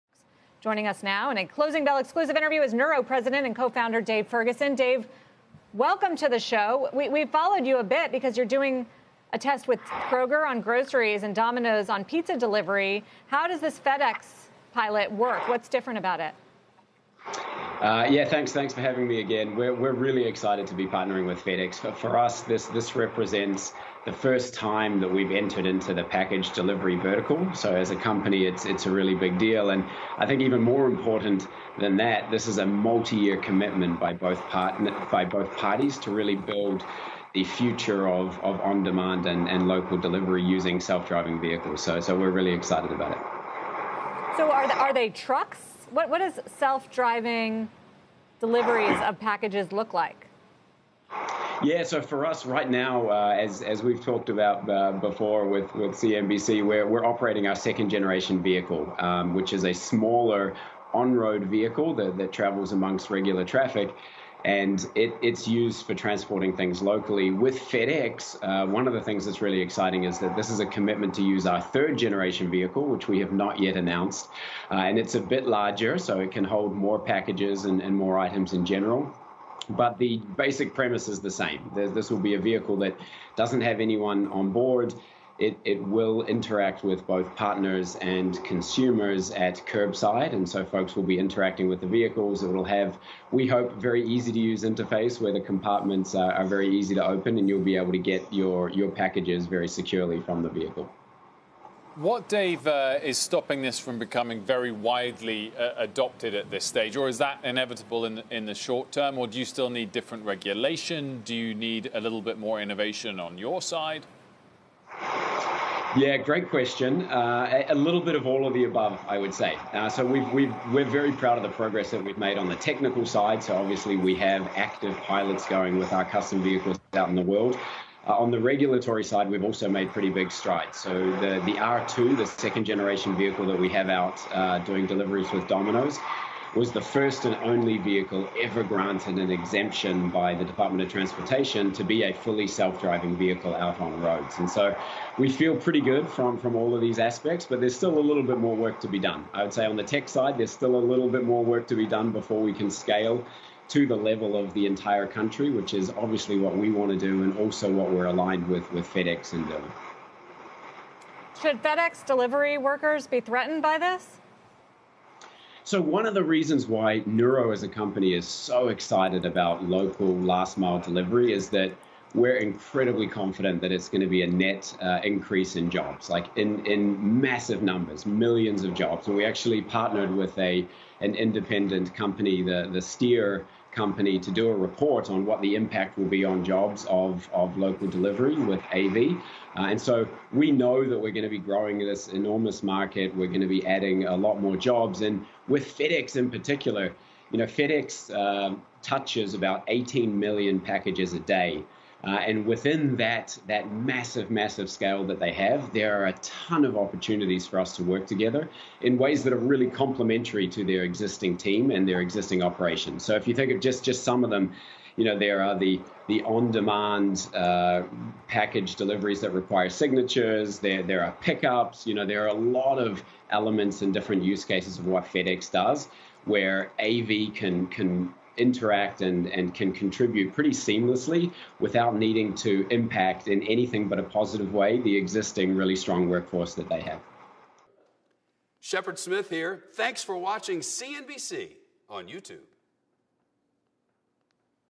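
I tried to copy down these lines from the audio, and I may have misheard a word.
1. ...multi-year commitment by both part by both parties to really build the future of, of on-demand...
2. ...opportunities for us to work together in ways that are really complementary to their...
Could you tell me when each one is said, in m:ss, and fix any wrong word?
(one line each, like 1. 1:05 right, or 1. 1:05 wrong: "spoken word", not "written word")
1. 0:32 right
2. 3:26 right.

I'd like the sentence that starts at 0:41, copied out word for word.
So so we're really excited about it.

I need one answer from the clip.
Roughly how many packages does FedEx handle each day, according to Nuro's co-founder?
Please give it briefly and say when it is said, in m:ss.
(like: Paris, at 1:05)
18 million, at 3:19.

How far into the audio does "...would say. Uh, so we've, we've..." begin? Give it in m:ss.
1:59.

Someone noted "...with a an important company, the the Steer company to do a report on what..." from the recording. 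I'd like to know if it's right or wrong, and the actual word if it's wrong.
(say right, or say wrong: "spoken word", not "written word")
wrong: "independent", not "important".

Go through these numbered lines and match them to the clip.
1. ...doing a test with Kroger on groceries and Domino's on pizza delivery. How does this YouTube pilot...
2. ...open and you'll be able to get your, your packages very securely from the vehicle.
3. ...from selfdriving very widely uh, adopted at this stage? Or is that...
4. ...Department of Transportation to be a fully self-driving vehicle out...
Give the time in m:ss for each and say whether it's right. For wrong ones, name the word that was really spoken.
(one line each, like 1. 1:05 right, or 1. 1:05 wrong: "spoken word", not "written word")
1. 0:08 wrong: "FedEx", not "YouTube"
2. 1:37 right
3. 1:43 wrong: "becoming", not "selfdriving"
4. 2:20 right.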